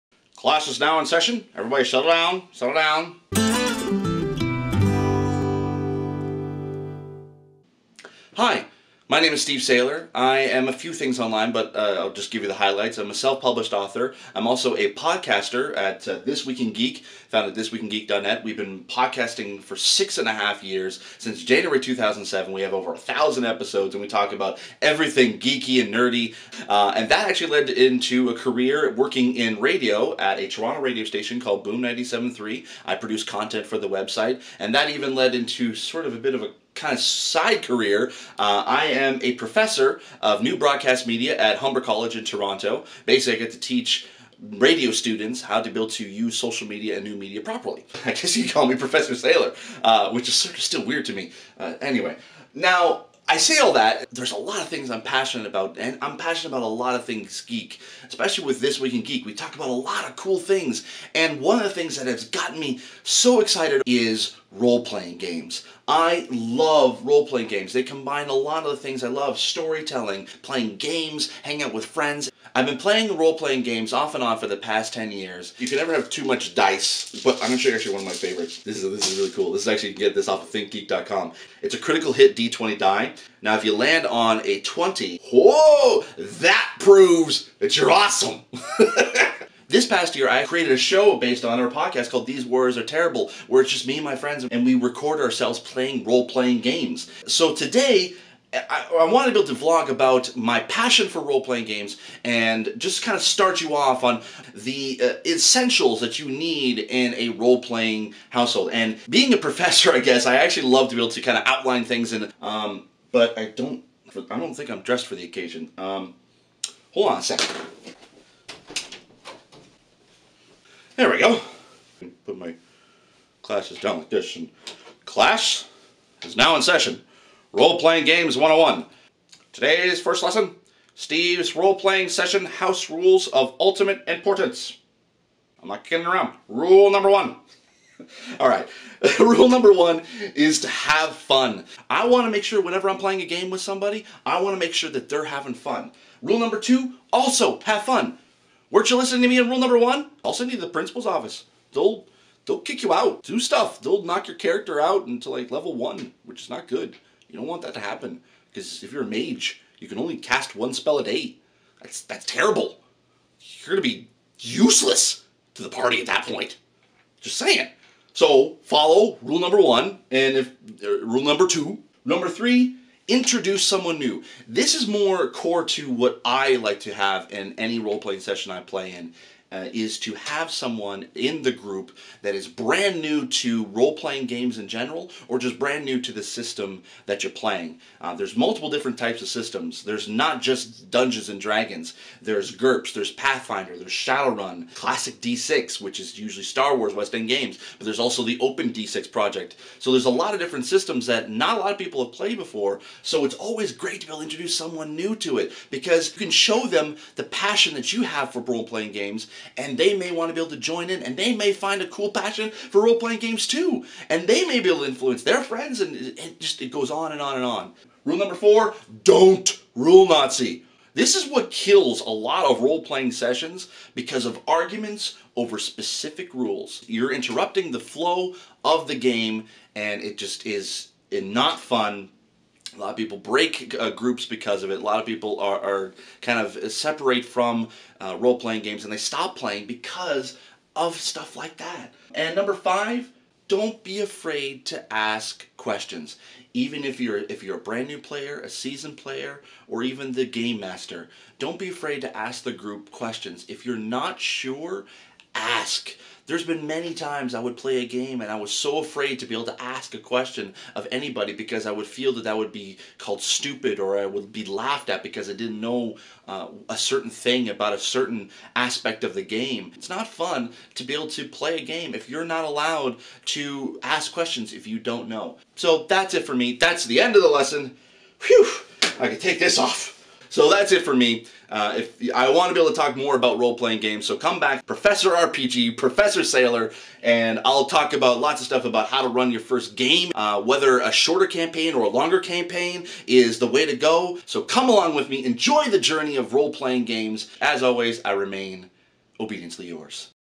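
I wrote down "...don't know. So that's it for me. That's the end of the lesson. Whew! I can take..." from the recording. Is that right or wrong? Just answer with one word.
right.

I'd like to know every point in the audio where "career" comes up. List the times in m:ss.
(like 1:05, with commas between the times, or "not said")
0:28, 0:37.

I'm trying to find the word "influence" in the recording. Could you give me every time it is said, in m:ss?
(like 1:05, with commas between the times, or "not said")
3:34.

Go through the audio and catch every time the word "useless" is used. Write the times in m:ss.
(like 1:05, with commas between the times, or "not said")
2:44.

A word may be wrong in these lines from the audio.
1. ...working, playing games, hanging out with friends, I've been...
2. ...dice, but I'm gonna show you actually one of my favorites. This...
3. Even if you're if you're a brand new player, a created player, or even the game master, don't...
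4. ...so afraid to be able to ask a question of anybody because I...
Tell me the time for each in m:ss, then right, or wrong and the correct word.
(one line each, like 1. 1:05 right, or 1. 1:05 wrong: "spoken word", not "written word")
1. 1:09 wrong: "storytelling", not "working"
2. 1:16 right
3. 4:06 wrong: "seasoned", not "created"
4. 4:18 right.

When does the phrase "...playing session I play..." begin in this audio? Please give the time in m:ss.
2:57.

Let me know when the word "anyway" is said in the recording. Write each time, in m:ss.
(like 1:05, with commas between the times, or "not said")
0:51.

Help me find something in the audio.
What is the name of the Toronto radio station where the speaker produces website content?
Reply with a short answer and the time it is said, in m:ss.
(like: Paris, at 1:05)
Boom 97.3, at 0:31.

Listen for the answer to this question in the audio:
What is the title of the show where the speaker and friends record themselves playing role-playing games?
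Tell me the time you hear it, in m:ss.
1:32.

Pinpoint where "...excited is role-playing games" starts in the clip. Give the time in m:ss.
1:03.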